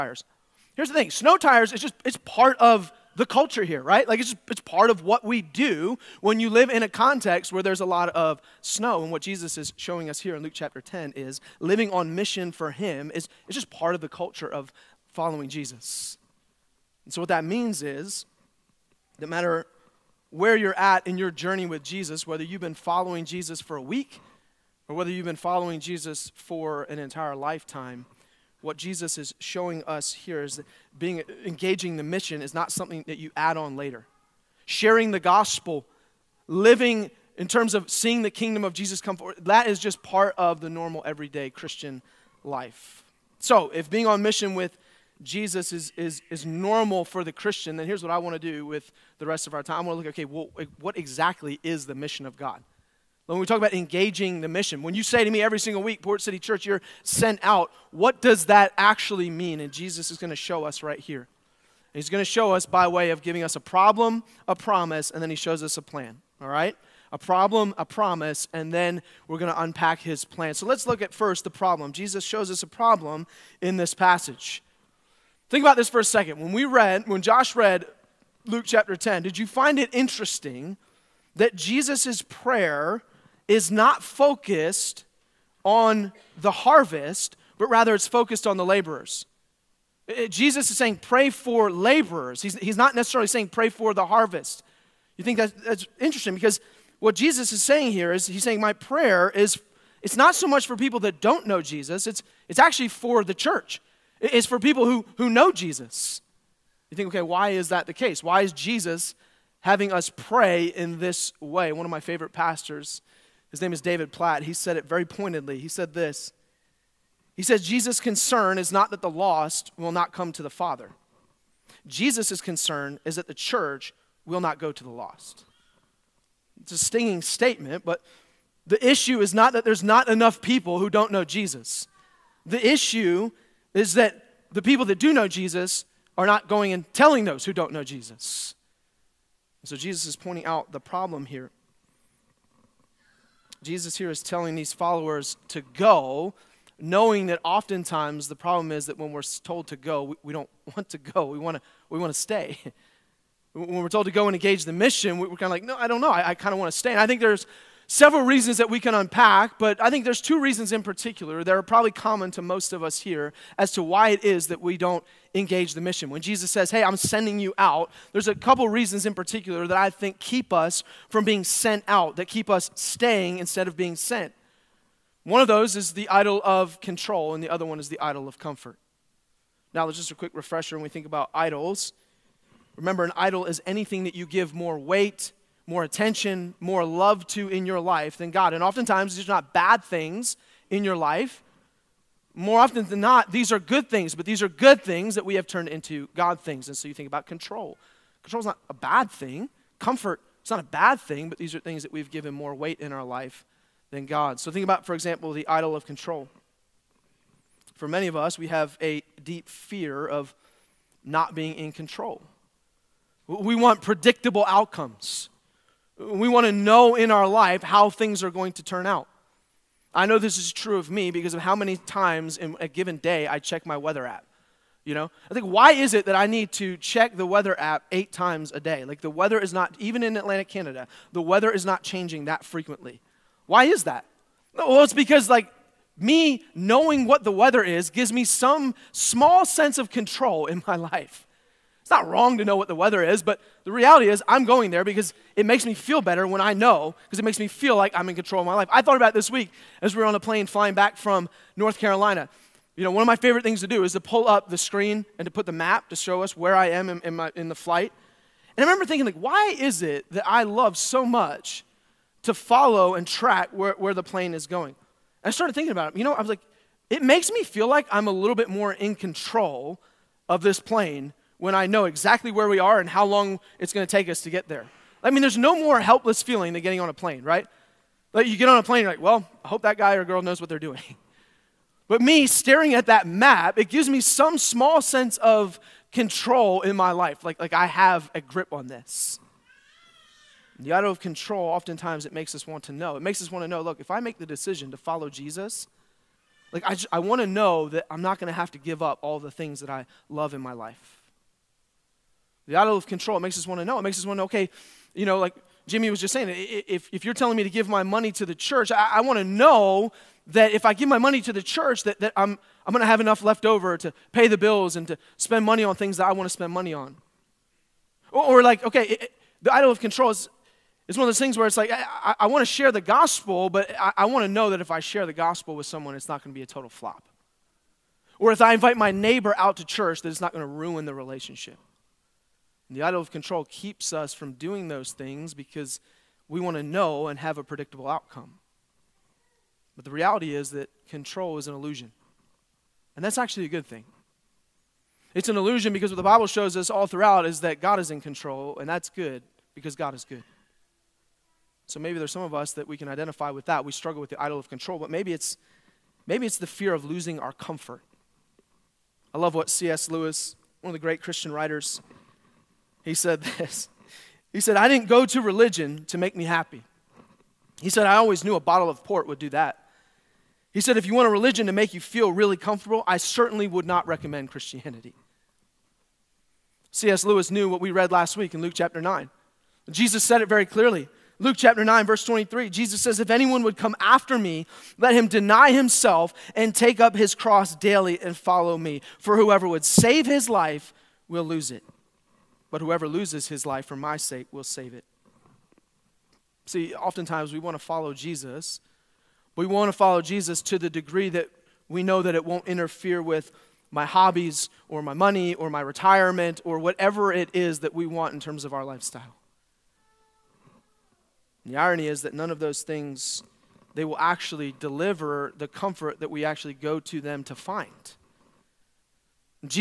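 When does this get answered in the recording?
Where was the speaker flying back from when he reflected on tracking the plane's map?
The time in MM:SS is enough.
04:11.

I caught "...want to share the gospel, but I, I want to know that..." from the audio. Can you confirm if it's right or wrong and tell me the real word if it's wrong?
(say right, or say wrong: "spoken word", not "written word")
right.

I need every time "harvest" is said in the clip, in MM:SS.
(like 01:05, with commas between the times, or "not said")
01:26, 01:34.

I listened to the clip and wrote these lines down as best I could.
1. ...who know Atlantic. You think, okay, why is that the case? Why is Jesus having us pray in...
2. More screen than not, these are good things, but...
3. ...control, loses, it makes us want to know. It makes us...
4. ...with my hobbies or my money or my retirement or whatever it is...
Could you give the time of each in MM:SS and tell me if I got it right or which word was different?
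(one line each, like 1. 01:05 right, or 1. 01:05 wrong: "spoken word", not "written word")
1. 01:45 wrong: "Jesus", not "Atlantic"
2. 03:12 wrong: "often", not "screen"
3. 04:50 wrong: "oftentimes", not "loses"
4. 06:43 right.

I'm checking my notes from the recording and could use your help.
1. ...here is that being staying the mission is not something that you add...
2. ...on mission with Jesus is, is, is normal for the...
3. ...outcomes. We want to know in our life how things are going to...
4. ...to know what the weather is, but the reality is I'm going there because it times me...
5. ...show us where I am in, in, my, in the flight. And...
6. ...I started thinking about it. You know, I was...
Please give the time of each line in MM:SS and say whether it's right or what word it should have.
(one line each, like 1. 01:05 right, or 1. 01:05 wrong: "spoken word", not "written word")
1. 00:30 wrong: "engaging", not "staying"
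2. 00:44 right
3. 03:34 right
4. 04:02 wrong: "makes", not "times"
5. 04:15 right
6. 04:25 right.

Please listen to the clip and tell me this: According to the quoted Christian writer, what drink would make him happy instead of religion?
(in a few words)
A bottle of port.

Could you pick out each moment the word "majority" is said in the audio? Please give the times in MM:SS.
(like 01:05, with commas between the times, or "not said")
not said.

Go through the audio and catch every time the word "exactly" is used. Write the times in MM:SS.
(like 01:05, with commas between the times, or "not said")
00:50, 04:31.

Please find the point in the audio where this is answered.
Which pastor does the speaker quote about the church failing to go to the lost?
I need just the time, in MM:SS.
01:53.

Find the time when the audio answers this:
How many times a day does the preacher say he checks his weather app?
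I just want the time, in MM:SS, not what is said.
03:47.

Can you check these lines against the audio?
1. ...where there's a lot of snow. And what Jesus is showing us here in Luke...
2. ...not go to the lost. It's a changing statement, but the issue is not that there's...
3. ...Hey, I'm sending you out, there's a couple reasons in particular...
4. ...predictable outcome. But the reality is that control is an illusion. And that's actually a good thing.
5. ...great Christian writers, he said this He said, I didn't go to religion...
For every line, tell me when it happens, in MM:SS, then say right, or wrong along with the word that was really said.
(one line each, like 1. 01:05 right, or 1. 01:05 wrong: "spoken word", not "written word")
1. 00:07 right
2. 02:04 wrong: "stinging", not "changing"
3. 02:46 right
4. 05:37 right
5. 06:00 right.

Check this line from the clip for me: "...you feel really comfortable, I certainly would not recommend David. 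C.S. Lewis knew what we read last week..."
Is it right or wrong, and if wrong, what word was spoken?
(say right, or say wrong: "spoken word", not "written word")
wrong: "Christianity", not "David".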